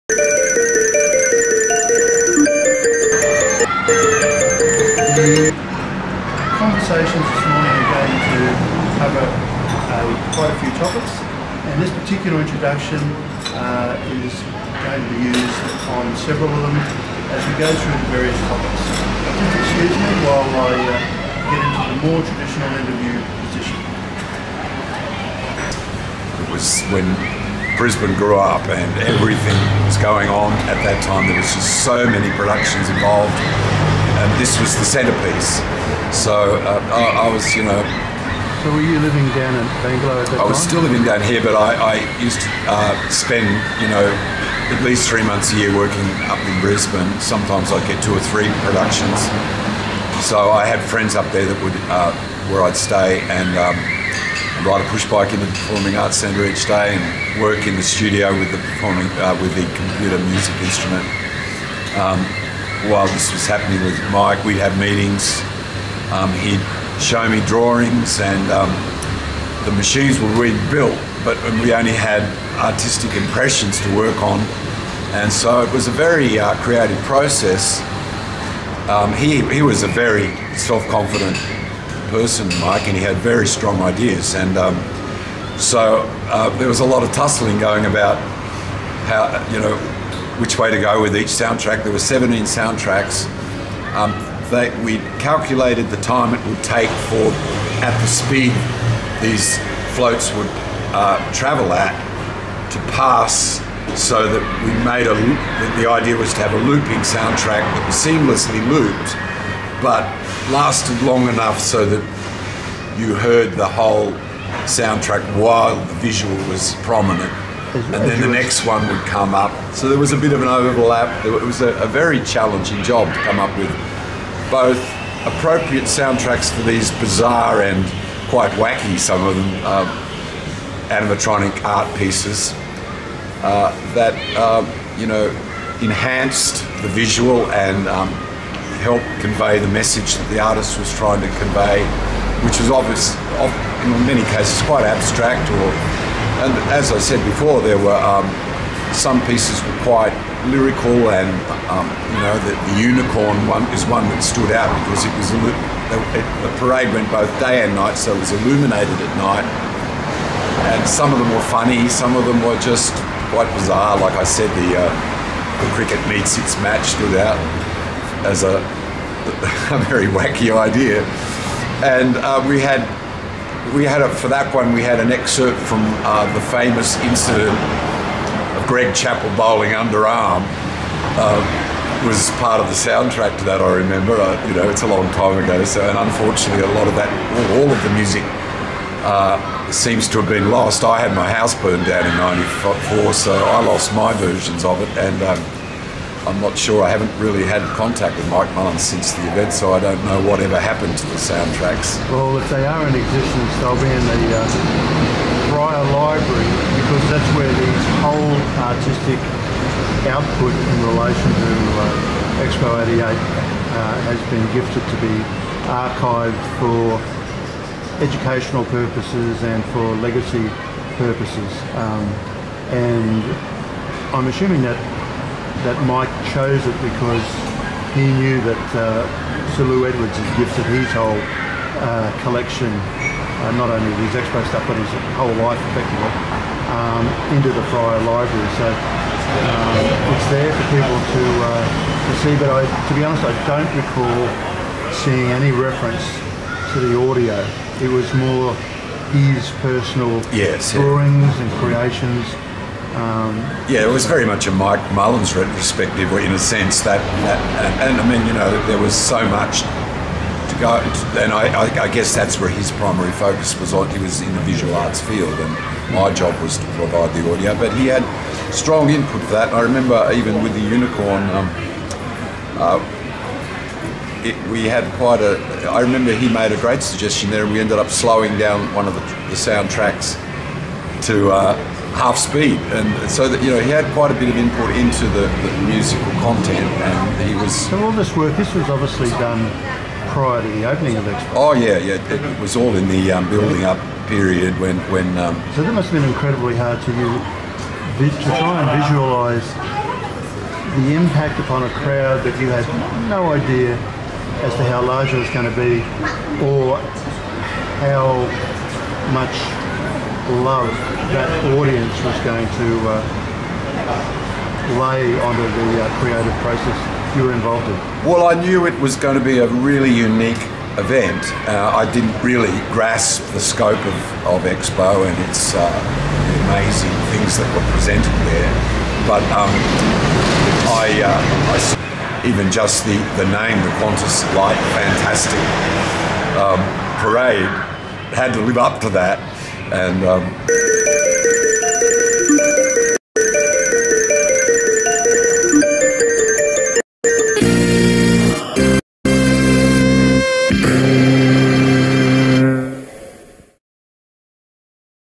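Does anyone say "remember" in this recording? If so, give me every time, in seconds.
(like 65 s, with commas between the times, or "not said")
183 s, 269 s, 275 s.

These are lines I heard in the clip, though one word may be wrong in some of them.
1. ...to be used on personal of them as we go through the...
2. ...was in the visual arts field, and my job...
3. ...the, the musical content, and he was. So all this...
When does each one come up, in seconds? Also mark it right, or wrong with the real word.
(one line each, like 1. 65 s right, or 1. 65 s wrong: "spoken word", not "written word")
1. 14 s wrong: "several", not "personal"
2. 263 s right
3. 285 s right.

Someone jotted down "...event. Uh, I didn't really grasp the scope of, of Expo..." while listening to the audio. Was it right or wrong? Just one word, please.
right.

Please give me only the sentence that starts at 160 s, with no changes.
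And some of them were funny, some of them were just quite bizarre.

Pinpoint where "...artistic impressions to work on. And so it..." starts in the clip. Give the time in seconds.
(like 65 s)
72 s.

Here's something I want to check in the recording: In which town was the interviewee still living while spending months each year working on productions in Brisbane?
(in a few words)
Bangalow.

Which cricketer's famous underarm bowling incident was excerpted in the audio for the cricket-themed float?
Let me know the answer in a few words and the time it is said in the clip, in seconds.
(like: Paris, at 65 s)
Greg Chappell, at 178 s.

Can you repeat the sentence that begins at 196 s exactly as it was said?
I haven't really had contact with Mike Mullins since the event, so I don't know whatever happened to the soundtracks.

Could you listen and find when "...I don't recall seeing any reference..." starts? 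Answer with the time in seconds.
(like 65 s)
243 s.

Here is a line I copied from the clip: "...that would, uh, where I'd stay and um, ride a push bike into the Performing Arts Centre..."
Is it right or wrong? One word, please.
right.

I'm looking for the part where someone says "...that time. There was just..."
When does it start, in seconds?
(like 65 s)
30 s.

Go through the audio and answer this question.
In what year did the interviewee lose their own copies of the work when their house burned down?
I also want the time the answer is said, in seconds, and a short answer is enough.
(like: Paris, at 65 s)
1994, at 192 s.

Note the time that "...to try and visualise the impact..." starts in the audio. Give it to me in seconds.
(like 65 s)
297 s.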